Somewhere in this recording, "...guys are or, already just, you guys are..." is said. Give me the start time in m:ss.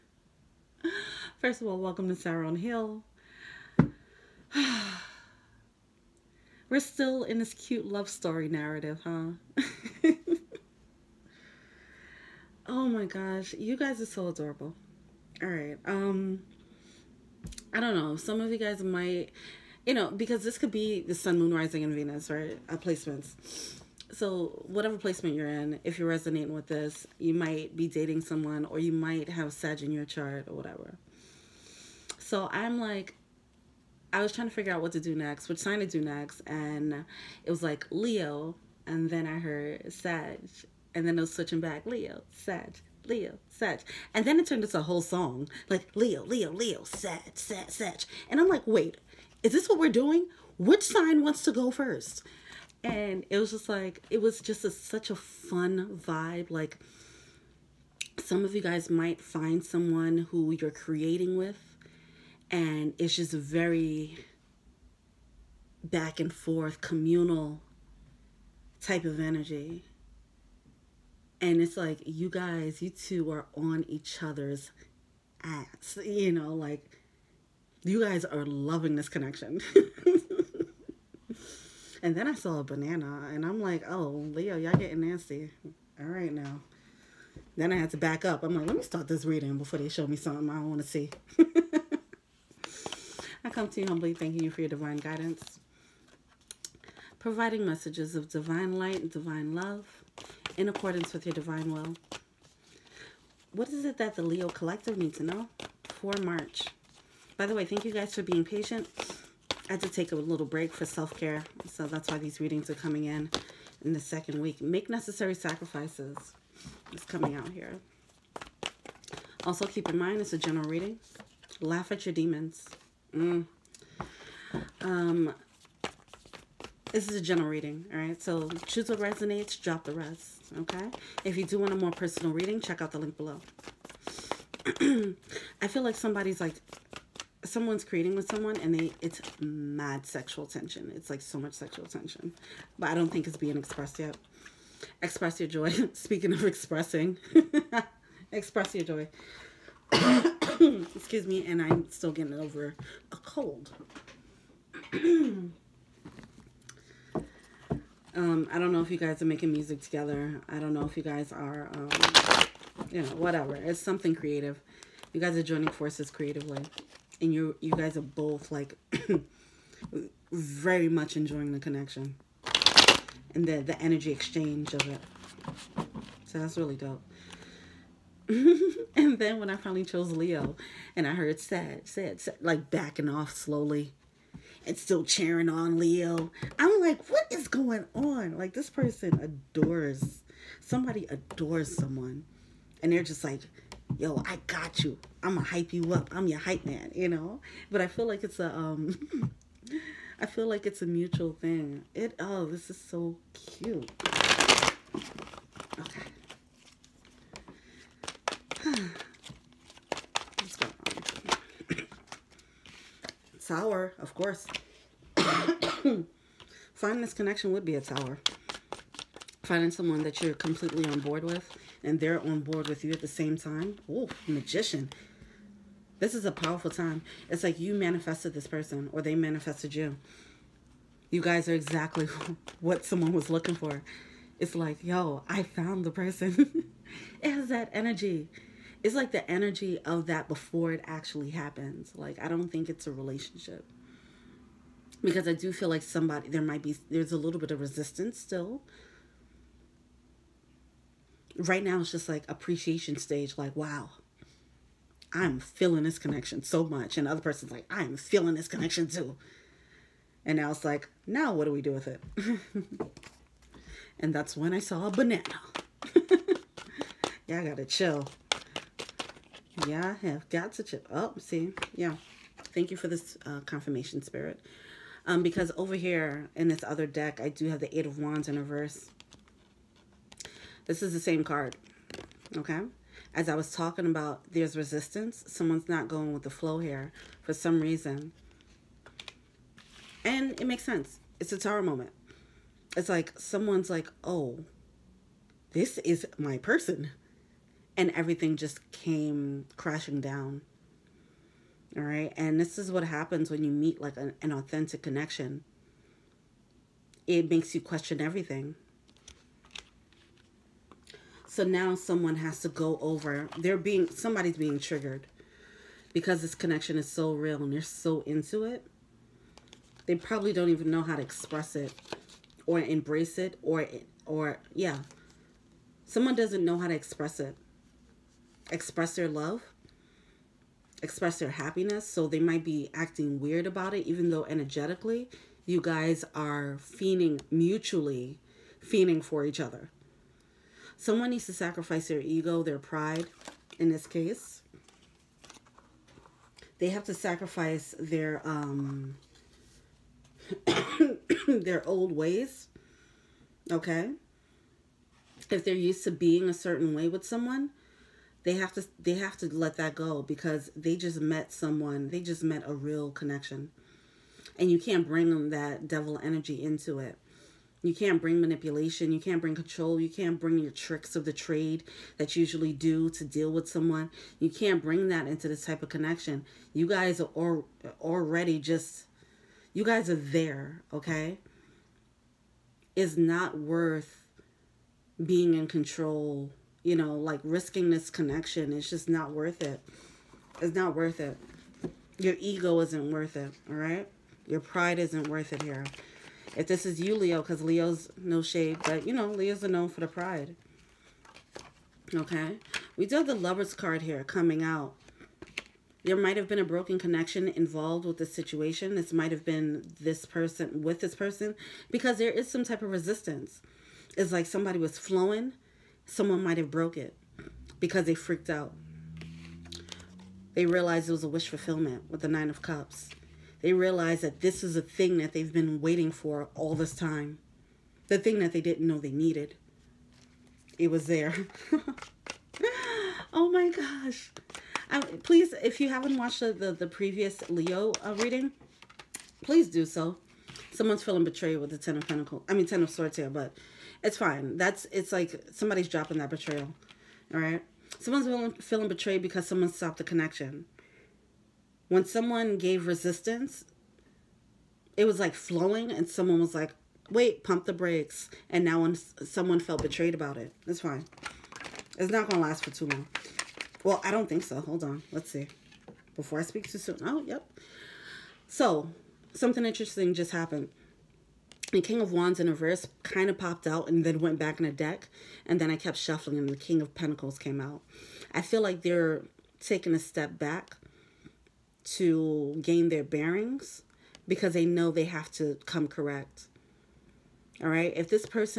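6:16.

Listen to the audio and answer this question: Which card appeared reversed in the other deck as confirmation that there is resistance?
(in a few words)
Eight of Wands.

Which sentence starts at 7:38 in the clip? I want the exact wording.
And now when someone felt betrayed about it, it's fine.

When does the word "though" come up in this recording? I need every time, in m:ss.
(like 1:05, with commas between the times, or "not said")
5:34.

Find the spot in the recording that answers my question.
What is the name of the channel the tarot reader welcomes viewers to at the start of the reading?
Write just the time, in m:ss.
0:02.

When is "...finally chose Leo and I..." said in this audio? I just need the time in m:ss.
2:59.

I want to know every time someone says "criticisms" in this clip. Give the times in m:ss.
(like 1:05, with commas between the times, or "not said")
not said.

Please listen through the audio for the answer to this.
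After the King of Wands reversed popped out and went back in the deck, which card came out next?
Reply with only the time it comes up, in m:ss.
7:56.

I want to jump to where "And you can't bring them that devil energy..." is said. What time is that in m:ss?
6:04.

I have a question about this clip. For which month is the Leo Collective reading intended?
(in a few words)
March.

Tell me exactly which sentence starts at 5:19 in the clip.
They probably don't even know how to express it or embrace it or, or yeah.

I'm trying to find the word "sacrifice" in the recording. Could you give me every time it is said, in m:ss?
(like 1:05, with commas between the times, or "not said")
1:55, 5:41, 5:46.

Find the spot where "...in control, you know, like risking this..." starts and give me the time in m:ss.
6:25.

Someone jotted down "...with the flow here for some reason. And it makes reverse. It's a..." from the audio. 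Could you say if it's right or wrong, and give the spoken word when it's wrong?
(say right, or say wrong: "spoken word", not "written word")
wrong: "sense", not "reverse".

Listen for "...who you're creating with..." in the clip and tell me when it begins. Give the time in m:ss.
1:00.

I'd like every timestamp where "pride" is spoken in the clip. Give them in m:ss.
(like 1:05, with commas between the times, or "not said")
5:42, 6:34, 6:39.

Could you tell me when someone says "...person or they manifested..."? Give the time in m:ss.
3:48.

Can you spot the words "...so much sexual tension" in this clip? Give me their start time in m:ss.
2:21.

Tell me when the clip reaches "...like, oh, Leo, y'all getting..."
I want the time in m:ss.
1:23.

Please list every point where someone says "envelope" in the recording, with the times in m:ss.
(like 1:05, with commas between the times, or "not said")
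not said.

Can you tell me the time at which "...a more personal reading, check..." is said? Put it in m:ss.
2:11.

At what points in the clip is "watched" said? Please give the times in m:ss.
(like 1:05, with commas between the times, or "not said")
7:15.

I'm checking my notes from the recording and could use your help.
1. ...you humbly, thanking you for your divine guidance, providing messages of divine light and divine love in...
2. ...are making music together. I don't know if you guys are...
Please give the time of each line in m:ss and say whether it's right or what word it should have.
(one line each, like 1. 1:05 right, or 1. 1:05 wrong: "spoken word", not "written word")
1. 1:33 right
2. 2:39 right.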